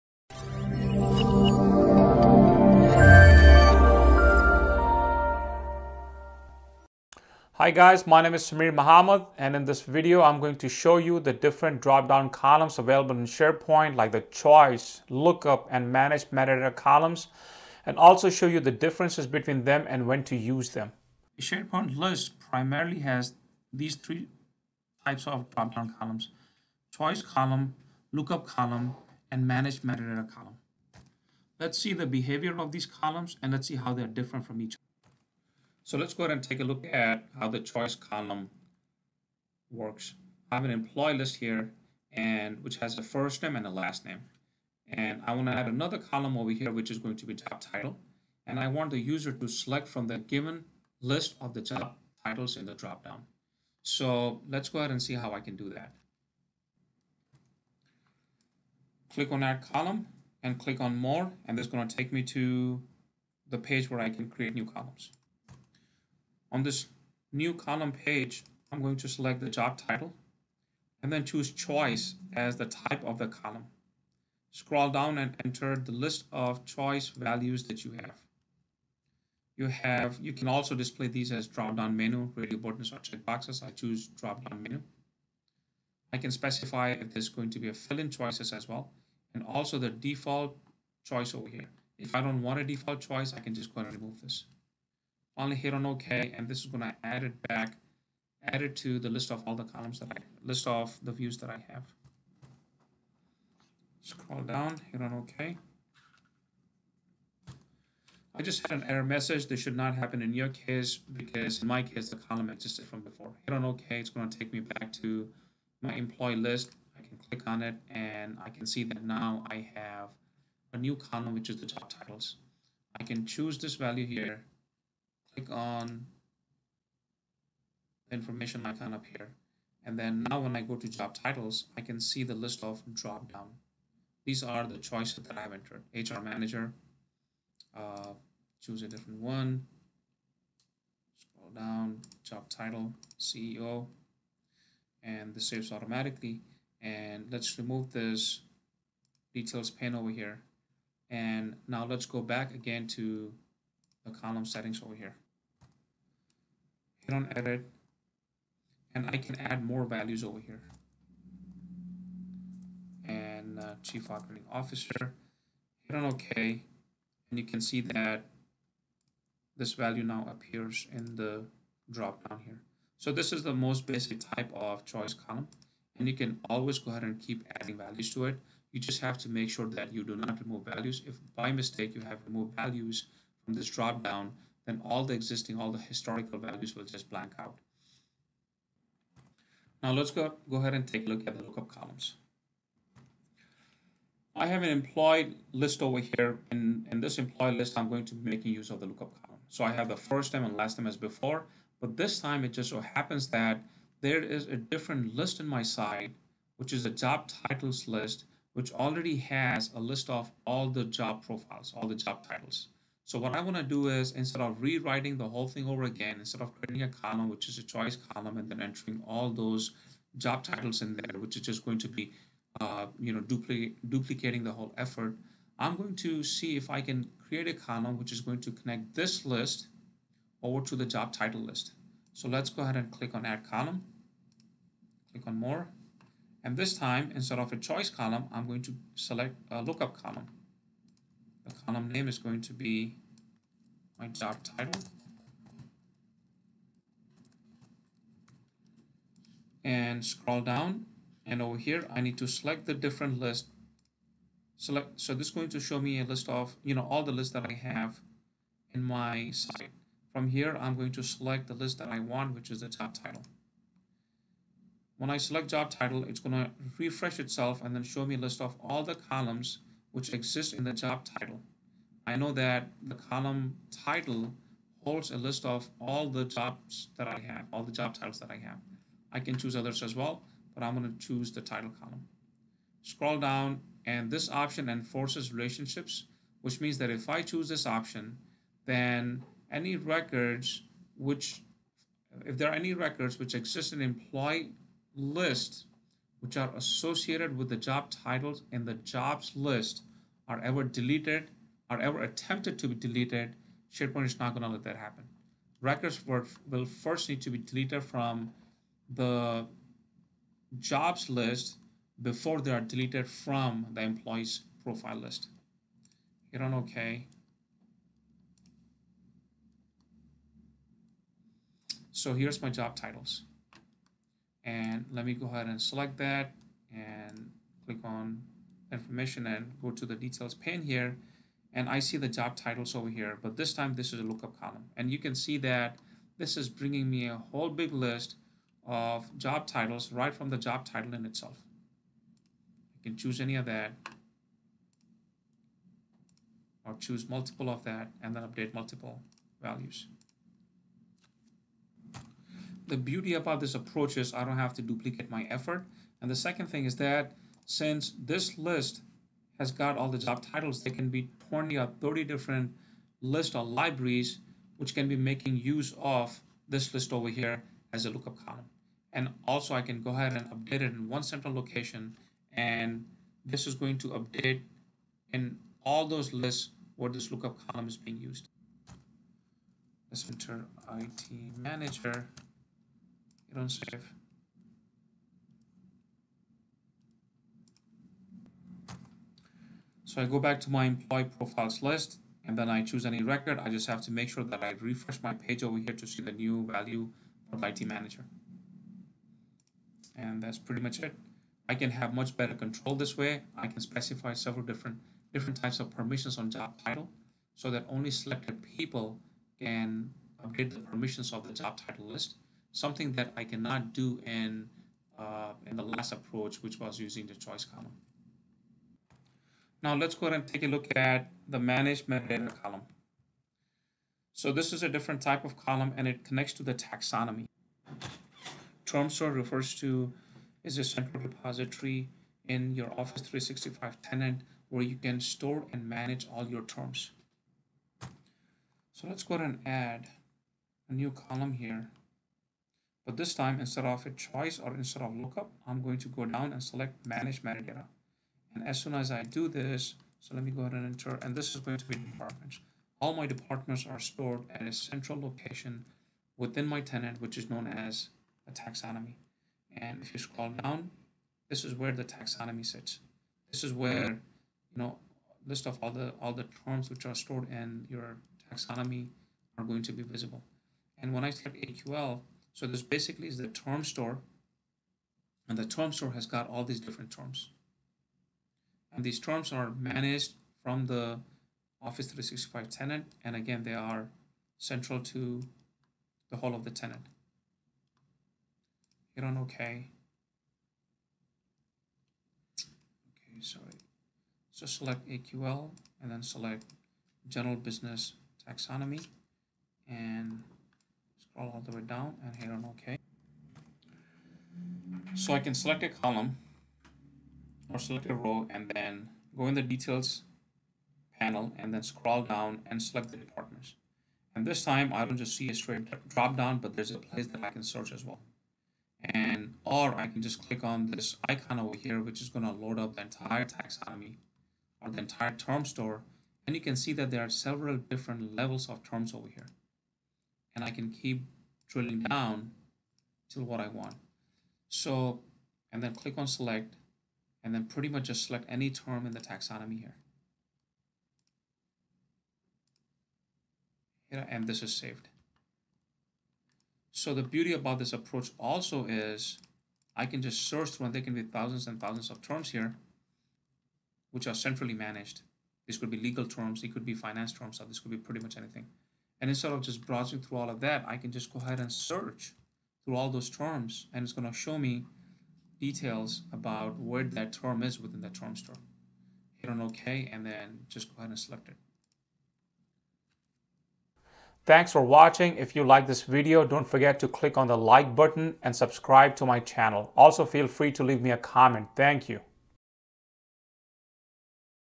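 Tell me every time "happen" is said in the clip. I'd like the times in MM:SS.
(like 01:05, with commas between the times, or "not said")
01:49, 03:22, 05:04.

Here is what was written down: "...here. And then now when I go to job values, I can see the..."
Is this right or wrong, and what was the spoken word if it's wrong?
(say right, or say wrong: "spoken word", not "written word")
wrong: "titles", not "values".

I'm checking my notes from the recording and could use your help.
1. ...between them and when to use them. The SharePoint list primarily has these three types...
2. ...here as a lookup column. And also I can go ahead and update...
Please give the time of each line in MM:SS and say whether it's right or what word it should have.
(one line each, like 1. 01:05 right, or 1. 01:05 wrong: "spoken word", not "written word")
1. 00:19 right
2. 06:07 right.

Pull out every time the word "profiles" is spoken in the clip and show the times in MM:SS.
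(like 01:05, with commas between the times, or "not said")
03:31, 05:14, 06:31.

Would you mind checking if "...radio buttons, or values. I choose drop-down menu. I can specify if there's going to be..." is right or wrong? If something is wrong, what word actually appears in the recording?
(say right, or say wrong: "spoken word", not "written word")
wrong: "checkboxes", not "values".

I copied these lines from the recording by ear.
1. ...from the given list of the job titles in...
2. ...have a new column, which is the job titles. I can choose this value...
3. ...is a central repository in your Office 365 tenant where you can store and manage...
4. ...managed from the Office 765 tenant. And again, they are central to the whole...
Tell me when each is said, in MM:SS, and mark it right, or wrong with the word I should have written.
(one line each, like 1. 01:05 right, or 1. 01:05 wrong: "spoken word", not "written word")
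1. 00:49 right
2. 01:59 right
3. 07:10 right
4. 07:59 wrong: "365", not "765".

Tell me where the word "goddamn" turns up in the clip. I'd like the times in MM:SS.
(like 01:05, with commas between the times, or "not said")
not said.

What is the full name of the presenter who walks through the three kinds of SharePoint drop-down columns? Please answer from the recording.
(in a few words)
Sameer Mohammed.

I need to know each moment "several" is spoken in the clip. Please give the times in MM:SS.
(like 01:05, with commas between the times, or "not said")
06:44, 08:47.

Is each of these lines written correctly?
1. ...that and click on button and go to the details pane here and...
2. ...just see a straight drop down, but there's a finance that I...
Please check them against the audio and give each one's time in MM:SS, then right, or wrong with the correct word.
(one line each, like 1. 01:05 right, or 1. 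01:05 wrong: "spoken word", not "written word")
1. 05:25 wrong: "information", not "button"
2. 08:34 wrong: "place", not "finance".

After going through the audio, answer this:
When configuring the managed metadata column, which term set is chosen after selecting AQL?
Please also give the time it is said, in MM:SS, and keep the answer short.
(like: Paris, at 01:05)
General Business Taxonomy, at 08:17.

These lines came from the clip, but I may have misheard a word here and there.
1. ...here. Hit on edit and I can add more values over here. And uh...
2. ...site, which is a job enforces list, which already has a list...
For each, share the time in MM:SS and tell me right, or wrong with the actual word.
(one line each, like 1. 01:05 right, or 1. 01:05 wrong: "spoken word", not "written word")
1. 02:34 right
2. 03:25 wrong: "titles", not "enforces".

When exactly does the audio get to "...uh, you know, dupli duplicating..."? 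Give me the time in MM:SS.
03:42.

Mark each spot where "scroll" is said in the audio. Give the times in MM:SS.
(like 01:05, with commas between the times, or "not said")
01:14, 01:44, 02:21, 04:10, 04:42, 07:39, 08:20, 08:31.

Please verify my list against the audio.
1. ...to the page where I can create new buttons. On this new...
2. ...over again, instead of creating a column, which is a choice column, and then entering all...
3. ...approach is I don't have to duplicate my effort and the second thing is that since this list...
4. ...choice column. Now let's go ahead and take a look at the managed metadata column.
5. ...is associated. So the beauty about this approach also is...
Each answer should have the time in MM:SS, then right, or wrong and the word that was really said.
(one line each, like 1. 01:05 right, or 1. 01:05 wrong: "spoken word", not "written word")
1. 01:02 wrong: "columns", not "buttons"
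2. 03:35 right
3. 05:53 right
4. 06:57 right
5. 09:04 wrong: "saved", not "associated".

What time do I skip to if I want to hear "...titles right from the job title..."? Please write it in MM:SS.
05:39.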